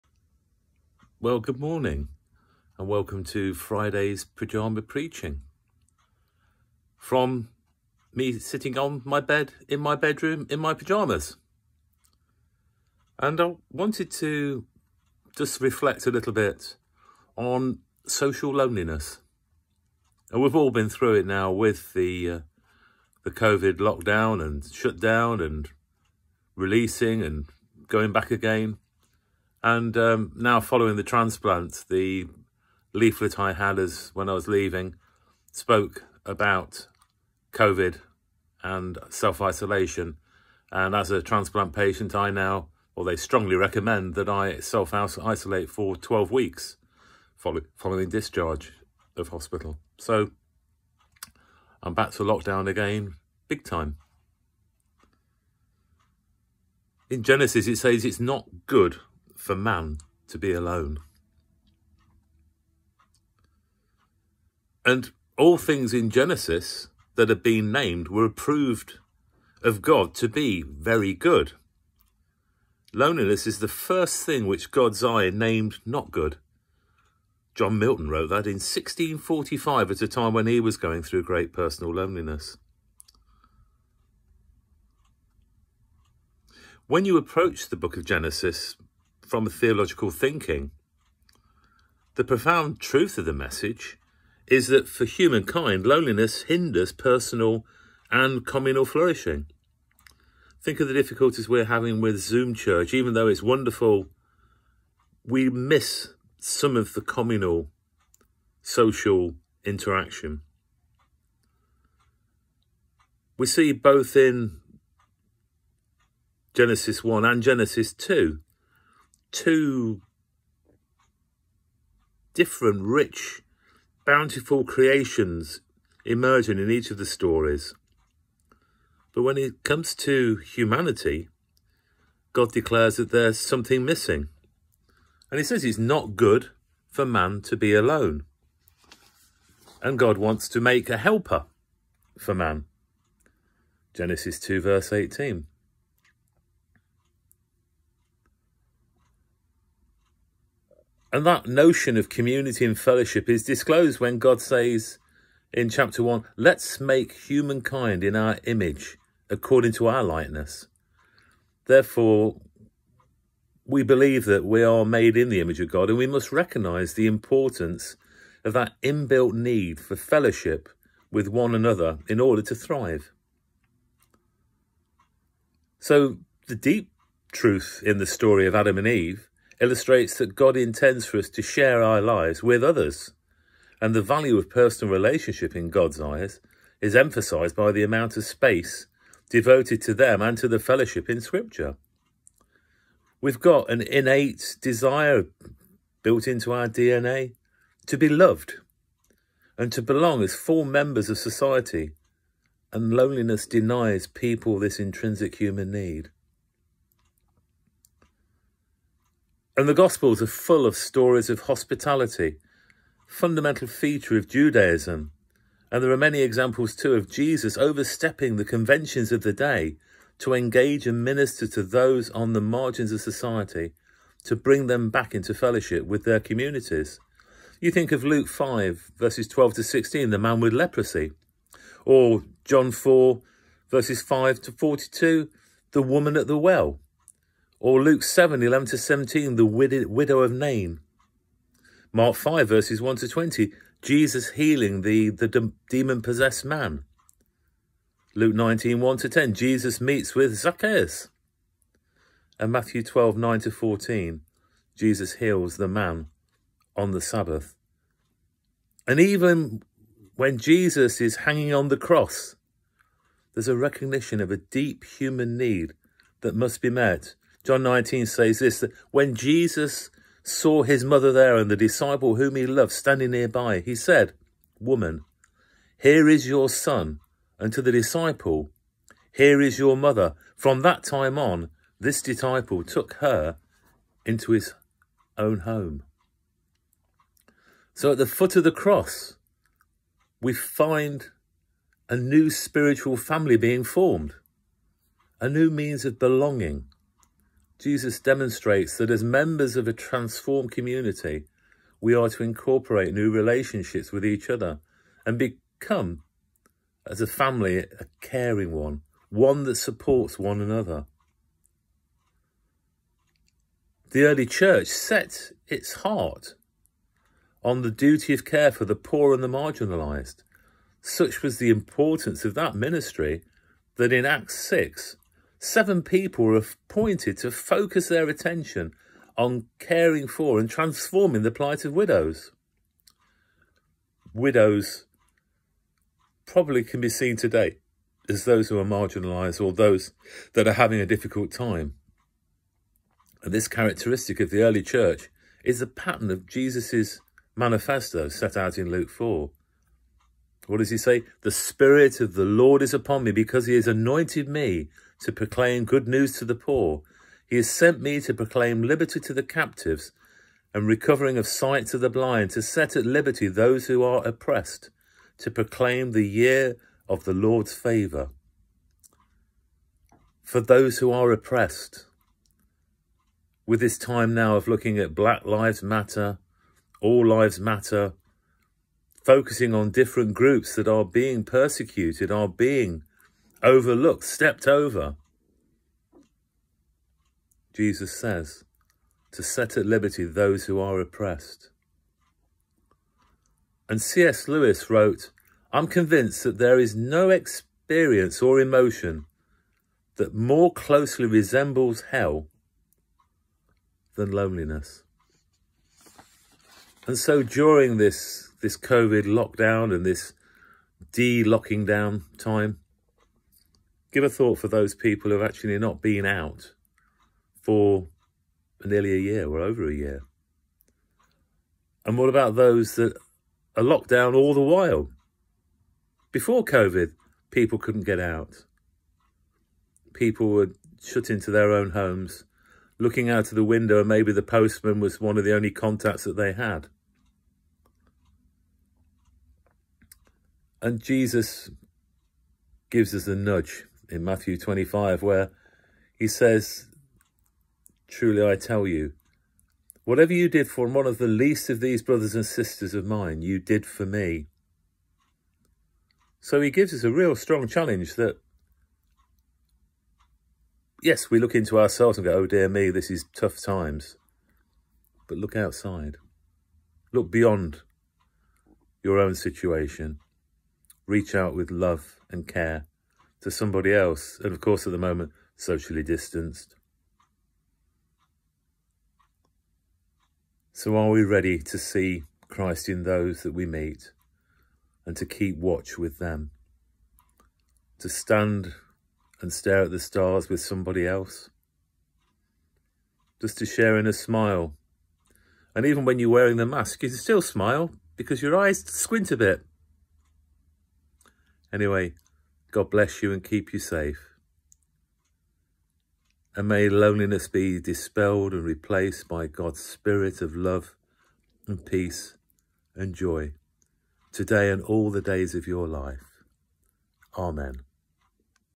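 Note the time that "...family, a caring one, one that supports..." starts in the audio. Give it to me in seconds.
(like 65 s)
307 s.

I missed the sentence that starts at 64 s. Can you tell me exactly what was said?
And all things in Genesis that have been named were approved of God to be very good.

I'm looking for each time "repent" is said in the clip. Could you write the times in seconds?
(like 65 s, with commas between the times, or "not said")
not said.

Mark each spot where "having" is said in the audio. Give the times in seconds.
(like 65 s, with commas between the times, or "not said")
101 s, 340 s.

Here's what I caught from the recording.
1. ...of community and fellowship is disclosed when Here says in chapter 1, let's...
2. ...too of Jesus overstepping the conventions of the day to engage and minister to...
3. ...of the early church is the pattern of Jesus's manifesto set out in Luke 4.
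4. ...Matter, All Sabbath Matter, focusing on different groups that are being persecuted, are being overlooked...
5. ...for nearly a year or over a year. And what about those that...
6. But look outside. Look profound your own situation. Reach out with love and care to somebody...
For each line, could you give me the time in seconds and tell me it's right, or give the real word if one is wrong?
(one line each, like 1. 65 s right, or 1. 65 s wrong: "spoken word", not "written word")
1. 151 s wrong: "God", not "Here"
2. 216 s right
3. 344 s right
4. 375 s wrong: "Lives", not "Sabbath"
5. 417 s right
6. 465 s wrong: "beyond", not "profound".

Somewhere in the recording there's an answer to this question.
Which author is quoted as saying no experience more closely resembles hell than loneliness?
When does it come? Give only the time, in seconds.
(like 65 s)
393 s.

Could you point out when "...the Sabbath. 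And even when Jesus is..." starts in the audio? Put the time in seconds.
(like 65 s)
256 s.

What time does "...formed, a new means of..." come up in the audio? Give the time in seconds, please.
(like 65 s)
293 s.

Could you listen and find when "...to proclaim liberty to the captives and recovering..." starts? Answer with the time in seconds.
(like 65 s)
358 s.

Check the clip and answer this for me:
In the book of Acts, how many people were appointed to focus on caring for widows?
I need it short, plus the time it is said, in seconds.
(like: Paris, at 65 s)
7, at 325 s.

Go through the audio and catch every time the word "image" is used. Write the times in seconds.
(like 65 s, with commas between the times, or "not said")
158 s, 165 s.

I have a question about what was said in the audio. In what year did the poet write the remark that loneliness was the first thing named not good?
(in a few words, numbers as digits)
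1645.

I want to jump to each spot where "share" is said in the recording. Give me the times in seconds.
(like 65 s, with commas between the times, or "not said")
181 s, 493 s.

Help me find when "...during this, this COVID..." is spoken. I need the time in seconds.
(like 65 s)
407 s.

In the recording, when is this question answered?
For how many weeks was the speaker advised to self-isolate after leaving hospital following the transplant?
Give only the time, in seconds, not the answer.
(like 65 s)
45 s.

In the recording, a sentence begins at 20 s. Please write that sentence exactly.
And we've all been through it now with the uh, the COVID lockdown and shutdown and releasing and going back again.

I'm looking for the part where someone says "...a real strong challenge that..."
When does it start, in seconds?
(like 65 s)
456 s.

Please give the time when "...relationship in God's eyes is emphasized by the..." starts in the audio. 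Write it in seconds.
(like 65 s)
184 s.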